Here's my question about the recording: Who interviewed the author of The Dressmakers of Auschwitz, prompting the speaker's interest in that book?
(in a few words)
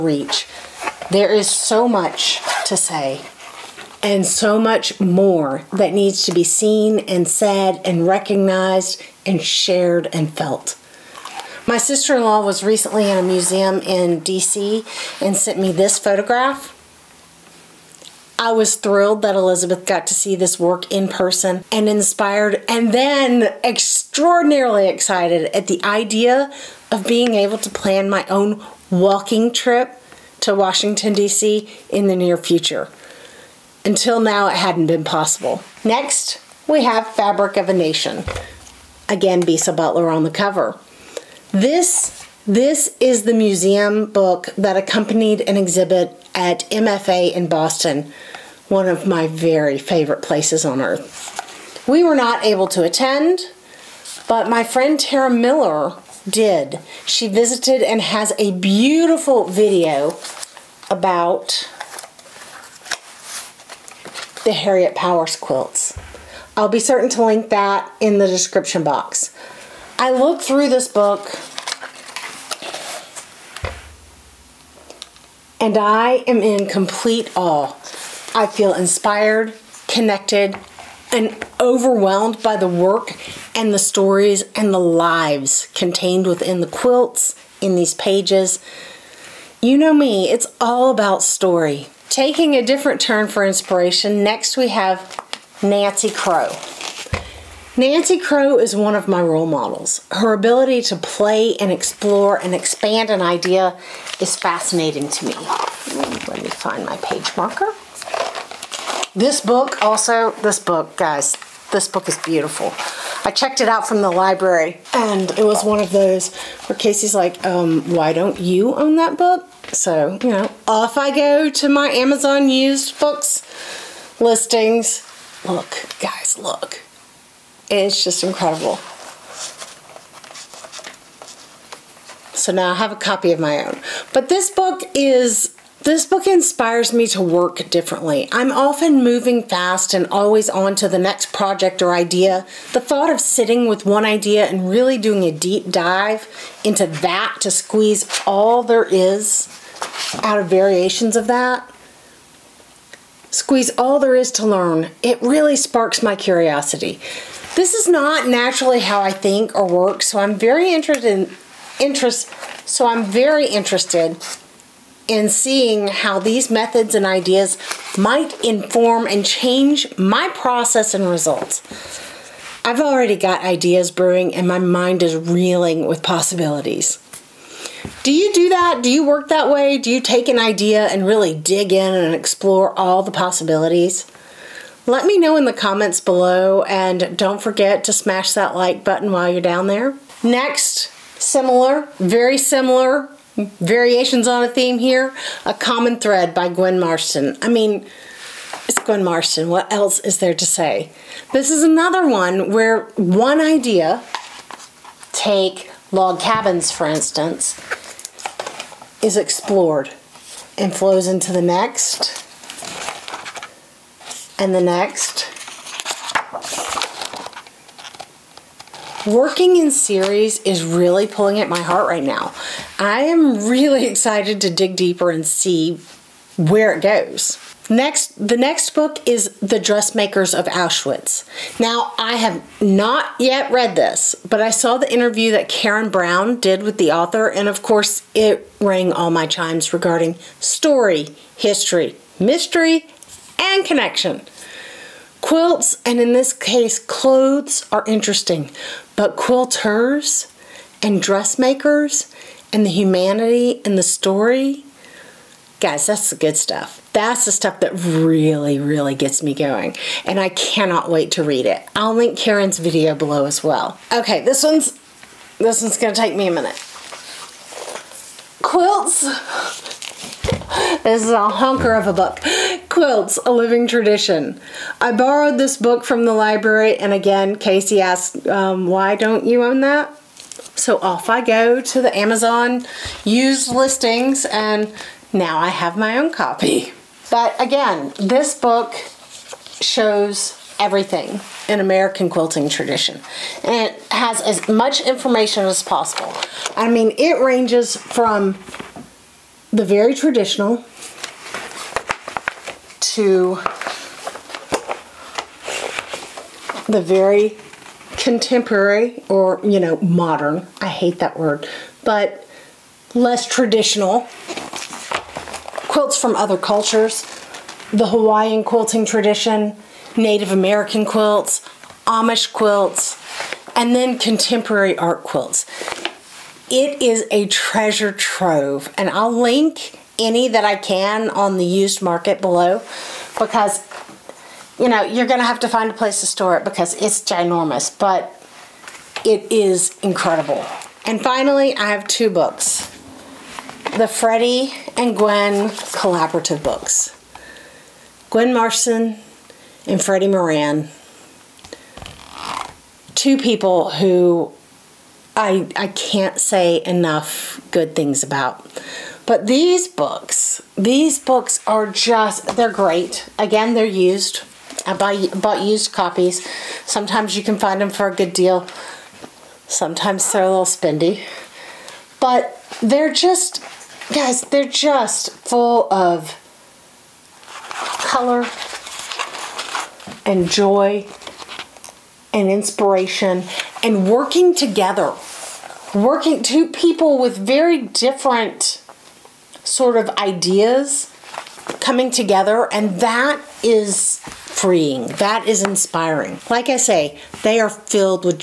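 Karen Brown.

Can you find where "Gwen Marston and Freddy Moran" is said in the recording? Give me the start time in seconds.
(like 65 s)
348 s.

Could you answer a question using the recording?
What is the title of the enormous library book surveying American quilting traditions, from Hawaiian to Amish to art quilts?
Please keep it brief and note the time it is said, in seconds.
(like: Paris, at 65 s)
Quilts, A Living Tradition, at 272 s.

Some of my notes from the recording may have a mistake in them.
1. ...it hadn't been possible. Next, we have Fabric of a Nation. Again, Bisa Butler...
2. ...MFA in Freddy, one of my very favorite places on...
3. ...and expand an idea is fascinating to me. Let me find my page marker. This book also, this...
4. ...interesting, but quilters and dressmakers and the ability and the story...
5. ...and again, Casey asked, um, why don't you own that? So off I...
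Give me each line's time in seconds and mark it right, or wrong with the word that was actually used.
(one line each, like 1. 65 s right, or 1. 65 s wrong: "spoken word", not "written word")
1. 34 s right
2. 46 s wrong: "Boston", not "Freddy"
3. 102 s right
4. 247 s wrong: "humanity", not "ability"
5. 276 s right.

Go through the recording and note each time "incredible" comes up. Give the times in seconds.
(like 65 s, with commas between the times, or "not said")
128 s, 339 s.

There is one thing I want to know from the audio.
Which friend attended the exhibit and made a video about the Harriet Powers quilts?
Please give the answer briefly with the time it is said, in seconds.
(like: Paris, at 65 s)
Tara Miller, at 54 s.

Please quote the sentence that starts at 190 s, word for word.
Next, similar, very similar variations on a theme here.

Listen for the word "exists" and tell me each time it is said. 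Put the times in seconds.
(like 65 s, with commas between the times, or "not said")
not said.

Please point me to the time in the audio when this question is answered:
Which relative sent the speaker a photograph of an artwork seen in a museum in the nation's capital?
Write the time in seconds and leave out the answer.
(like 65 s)
11 s.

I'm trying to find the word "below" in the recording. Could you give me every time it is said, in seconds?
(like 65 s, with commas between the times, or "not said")
185 s, 262 s, 332 s.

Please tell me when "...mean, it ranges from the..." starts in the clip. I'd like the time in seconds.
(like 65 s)
296 s.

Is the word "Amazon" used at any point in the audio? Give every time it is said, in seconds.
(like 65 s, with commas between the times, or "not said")
121 s, 281 s.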